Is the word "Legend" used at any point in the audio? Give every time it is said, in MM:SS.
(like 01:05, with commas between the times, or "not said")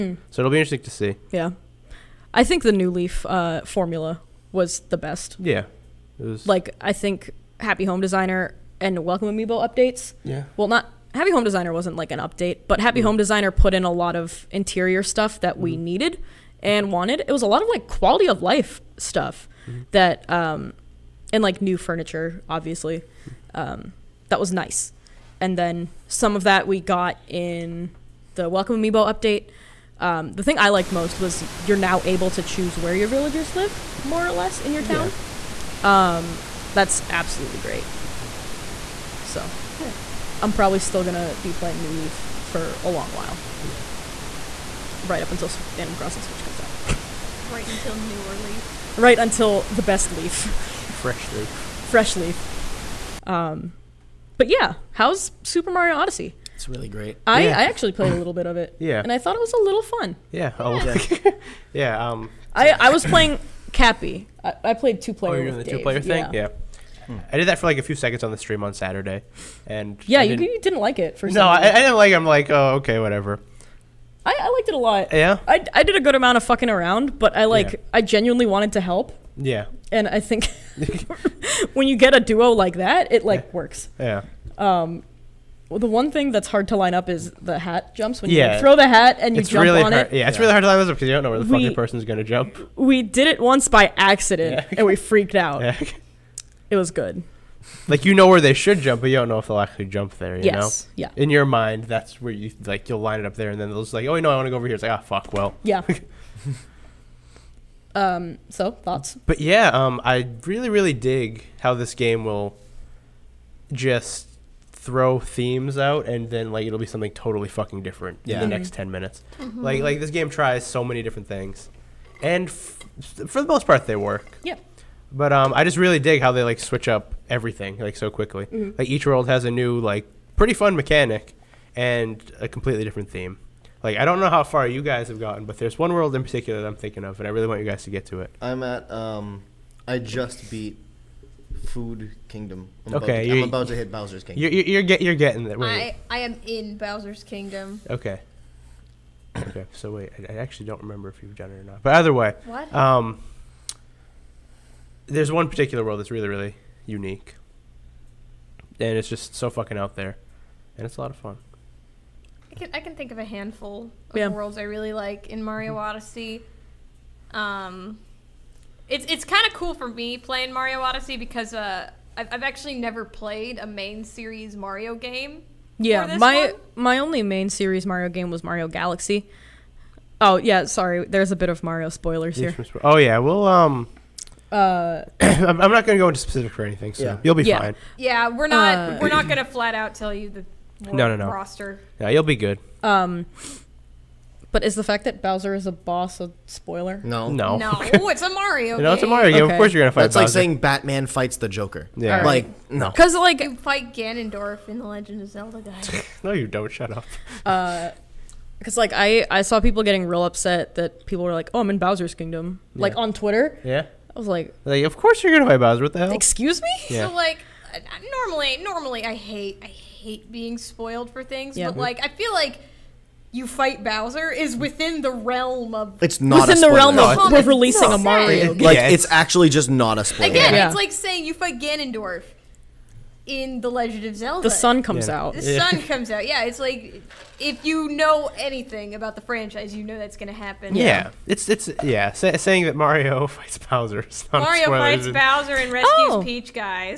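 03:24, 03:53.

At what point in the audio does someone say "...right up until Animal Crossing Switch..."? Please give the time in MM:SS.
00:45.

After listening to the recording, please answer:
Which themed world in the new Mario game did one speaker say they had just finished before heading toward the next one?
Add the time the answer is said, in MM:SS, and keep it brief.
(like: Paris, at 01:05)
Food Kingdom, at 02:21.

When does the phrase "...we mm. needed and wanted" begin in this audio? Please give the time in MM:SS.
00:15.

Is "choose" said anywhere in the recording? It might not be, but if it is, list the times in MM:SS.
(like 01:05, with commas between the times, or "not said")
00:32.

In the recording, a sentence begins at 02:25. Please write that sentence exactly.
I I am in Bowser's Kingdom.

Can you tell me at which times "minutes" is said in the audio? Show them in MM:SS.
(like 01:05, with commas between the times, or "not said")
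01:58.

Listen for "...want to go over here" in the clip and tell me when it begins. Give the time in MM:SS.
01:44.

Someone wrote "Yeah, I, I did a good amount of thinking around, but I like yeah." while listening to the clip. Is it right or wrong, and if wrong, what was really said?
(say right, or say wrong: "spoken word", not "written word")
wrong: "fucking", not "thinking".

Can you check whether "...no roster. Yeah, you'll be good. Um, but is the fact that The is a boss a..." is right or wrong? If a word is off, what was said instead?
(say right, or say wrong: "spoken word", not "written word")
wrong: "Bowser", not "The".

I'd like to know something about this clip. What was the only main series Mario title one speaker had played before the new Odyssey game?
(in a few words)
Mario Galaxy.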